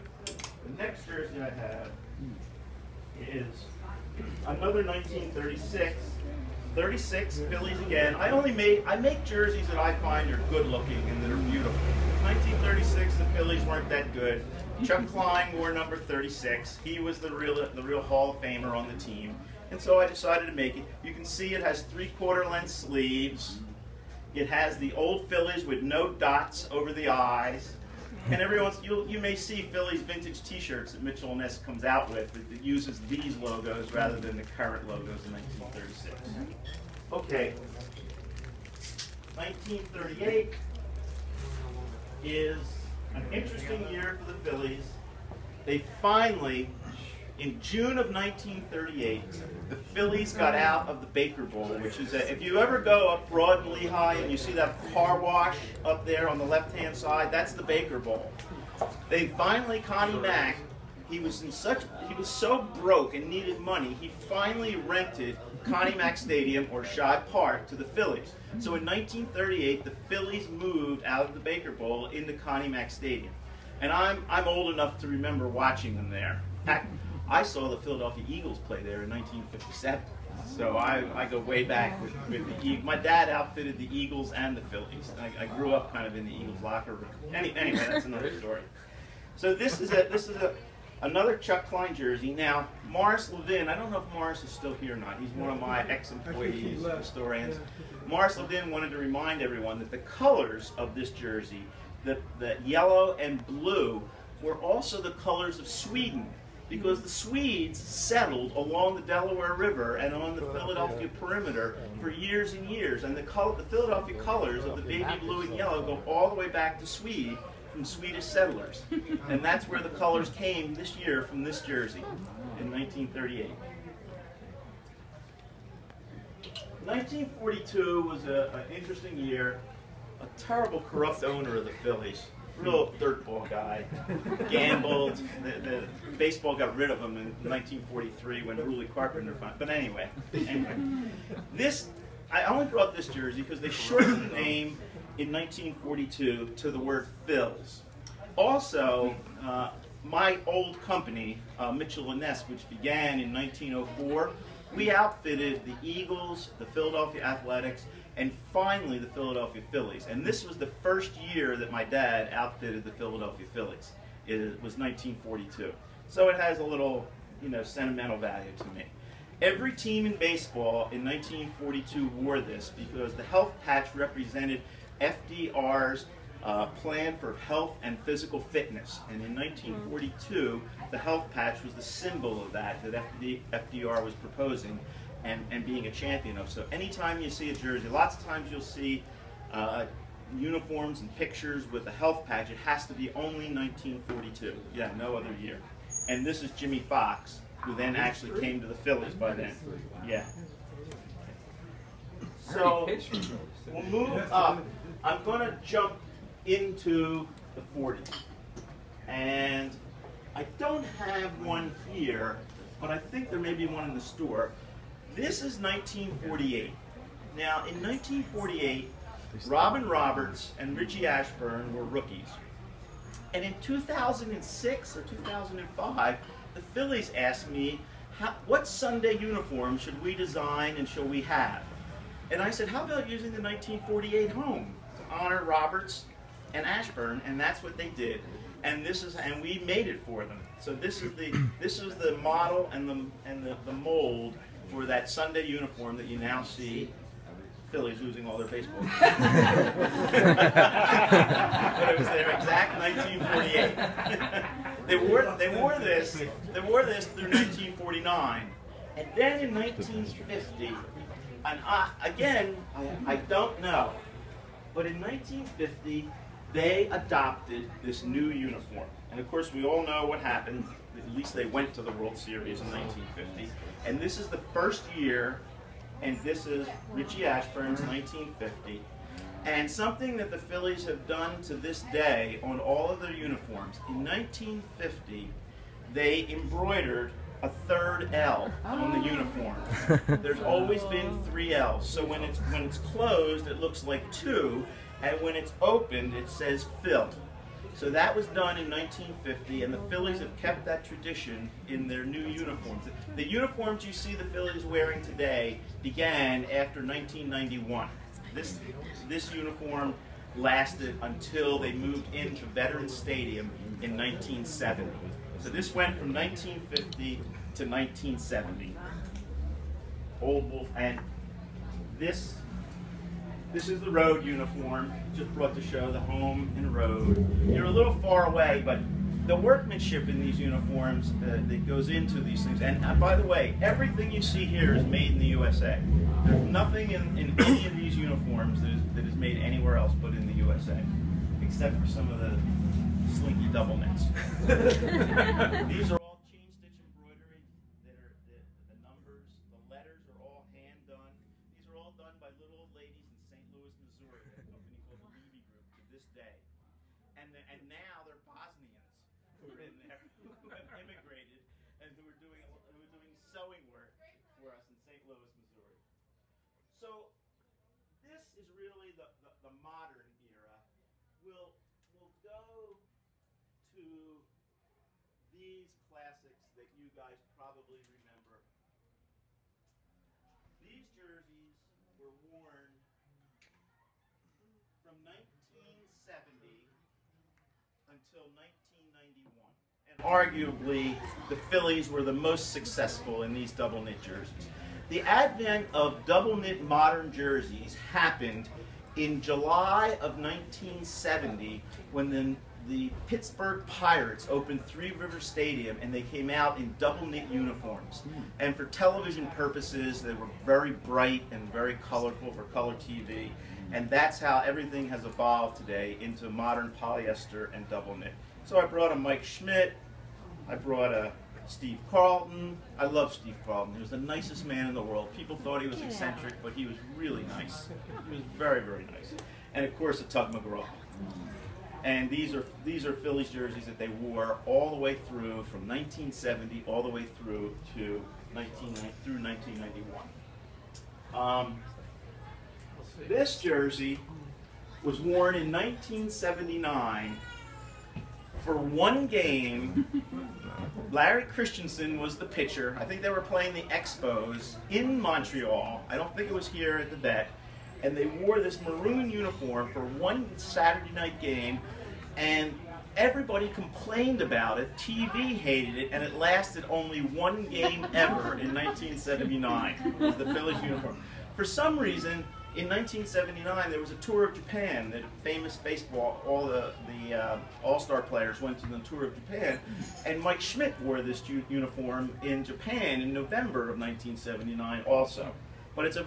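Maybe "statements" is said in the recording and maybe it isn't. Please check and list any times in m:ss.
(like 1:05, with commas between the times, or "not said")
not said.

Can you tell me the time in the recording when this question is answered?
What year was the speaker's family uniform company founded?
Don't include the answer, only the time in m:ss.
2:33.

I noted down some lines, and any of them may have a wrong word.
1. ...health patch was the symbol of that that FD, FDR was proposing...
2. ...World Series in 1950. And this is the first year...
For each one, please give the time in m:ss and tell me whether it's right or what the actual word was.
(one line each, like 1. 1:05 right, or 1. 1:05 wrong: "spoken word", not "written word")
1. 3:00 right
2. 4:31 right.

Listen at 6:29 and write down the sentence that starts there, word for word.
And arguably, the Phillies were the most successful in these double knit jerseys.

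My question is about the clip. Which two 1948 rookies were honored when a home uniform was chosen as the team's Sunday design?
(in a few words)
Robin Roberts and Richie Ashburn.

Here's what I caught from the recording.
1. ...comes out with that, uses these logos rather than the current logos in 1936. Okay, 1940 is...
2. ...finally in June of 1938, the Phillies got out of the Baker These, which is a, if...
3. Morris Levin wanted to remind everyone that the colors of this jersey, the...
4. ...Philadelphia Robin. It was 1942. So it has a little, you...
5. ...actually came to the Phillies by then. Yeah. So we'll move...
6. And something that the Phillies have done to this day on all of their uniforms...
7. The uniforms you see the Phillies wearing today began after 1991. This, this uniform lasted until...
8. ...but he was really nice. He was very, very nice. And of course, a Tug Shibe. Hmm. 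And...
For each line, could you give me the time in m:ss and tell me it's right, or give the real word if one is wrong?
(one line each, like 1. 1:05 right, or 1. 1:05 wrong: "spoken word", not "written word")
1. 0:31 wrong: "1938", not "1940"
2. 0:46 wrong: "Bowl", not "These"
3. 1:38 right
4. 2:42 wrong: "Phillies", not "Robin"
5. 3:17 right
6. 4:39 right
7. 5:03 right
8. 7:06 wrong: "McGraw", not "Shibe".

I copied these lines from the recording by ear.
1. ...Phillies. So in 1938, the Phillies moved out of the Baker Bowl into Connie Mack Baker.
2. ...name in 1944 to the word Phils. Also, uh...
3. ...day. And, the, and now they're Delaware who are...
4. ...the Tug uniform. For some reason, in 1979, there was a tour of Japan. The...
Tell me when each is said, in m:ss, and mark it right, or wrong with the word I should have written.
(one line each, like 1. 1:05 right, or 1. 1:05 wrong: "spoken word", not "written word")
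1. 1:07 wrong: "Stadium", not "Baker"
2. 2:24 wrong: "1942", not "1944"
3. 5:56 wrong: "Bosnians", not "Delaware"
4. 7:50 wrong: "Phillies", not "Tug".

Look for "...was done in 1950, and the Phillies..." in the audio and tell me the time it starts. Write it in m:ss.
4:58.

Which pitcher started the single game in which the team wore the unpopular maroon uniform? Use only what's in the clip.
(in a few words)
Larry Christenson.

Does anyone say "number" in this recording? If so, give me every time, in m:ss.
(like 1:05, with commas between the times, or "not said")
0:15, 5:48.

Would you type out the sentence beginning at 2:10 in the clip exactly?
A terrible corrupt owner of the Phillies real dirtball guy.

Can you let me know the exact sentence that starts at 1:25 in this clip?
I, I grew up kind of in the Eagles locker room.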